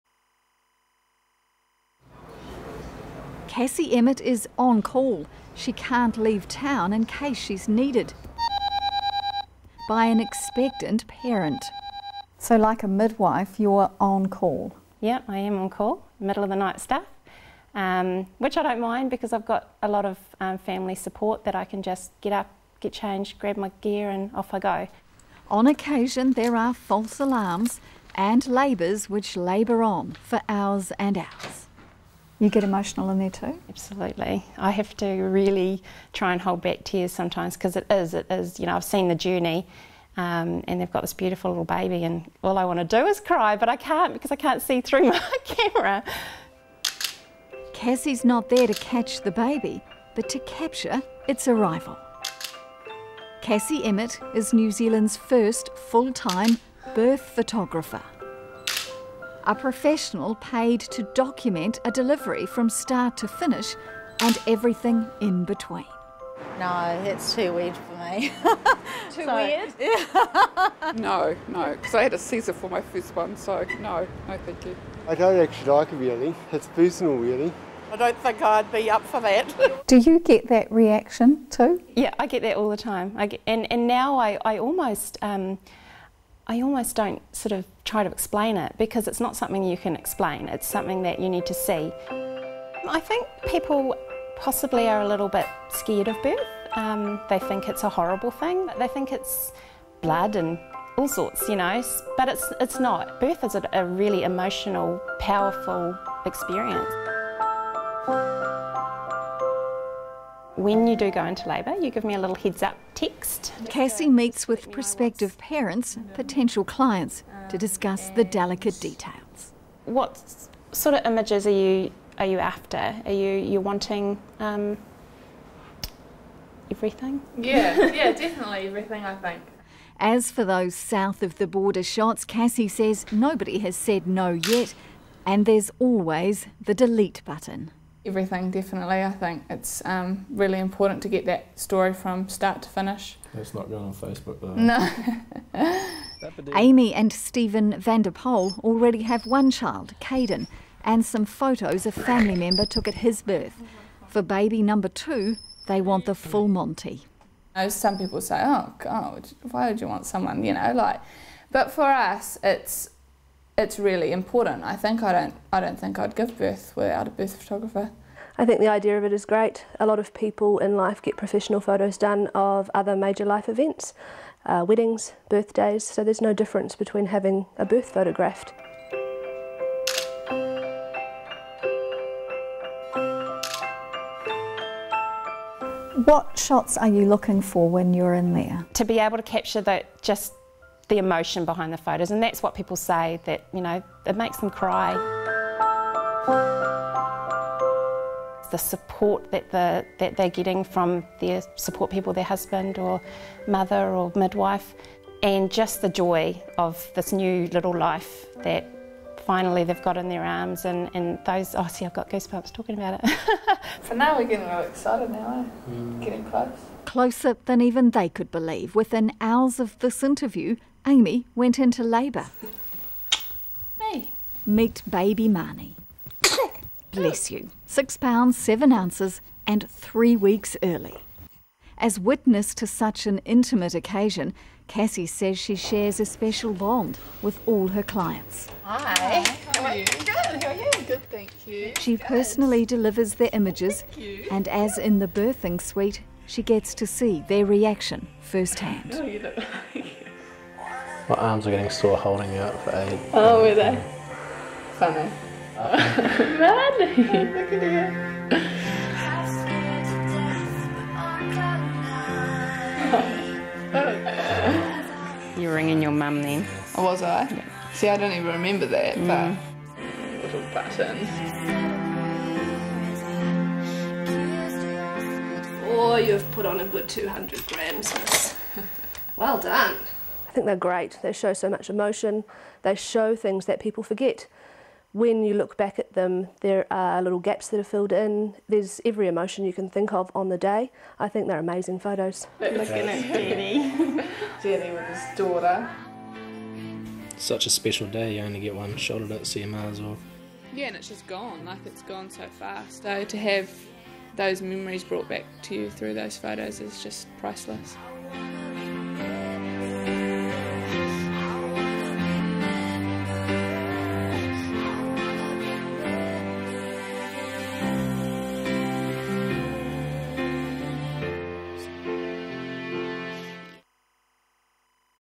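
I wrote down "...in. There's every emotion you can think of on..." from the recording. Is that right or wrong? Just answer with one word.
right.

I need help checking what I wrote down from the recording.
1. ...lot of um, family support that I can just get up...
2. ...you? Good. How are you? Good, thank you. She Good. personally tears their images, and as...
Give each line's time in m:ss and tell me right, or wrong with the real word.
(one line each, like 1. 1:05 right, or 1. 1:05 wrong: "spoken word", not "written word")
1. 0:19 right
2. 3:59 wrong: "delivers", not "tears".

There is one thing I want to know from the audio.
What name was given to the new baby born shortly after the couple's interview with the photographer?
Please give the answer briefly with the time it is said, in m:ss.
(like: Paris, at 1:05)
Marnie, at 3:45.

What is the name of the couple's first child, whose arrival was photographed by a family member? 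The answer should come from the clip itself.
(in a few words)
Caden.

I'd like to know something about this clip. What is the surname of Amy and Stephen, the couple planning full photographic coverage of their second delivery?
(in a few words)
Vanderpoel.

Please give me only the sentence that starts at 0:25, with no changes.
On occasion, there are false alarms and labours which labour on for hours and hours.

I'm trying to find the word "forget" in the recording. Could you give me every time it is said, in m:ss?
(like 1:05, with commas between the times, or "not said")
4:43.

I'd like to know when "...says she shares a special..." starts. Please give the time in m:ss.
3:55.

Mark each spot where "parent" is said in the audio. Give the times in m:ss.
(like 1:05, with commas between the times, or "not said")
0:11, 1:55.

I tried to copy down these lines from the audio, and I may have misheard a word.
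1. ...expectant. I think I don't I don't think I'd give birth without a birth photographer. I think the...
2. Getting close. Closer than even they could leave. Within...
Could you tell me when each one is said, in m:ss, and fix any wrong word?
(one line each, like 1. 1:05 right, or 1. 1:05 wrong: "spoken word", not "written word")
1. 2:44 wrong: "important", not "expectant"
2. 3:36 wrong: "believe", not "leave".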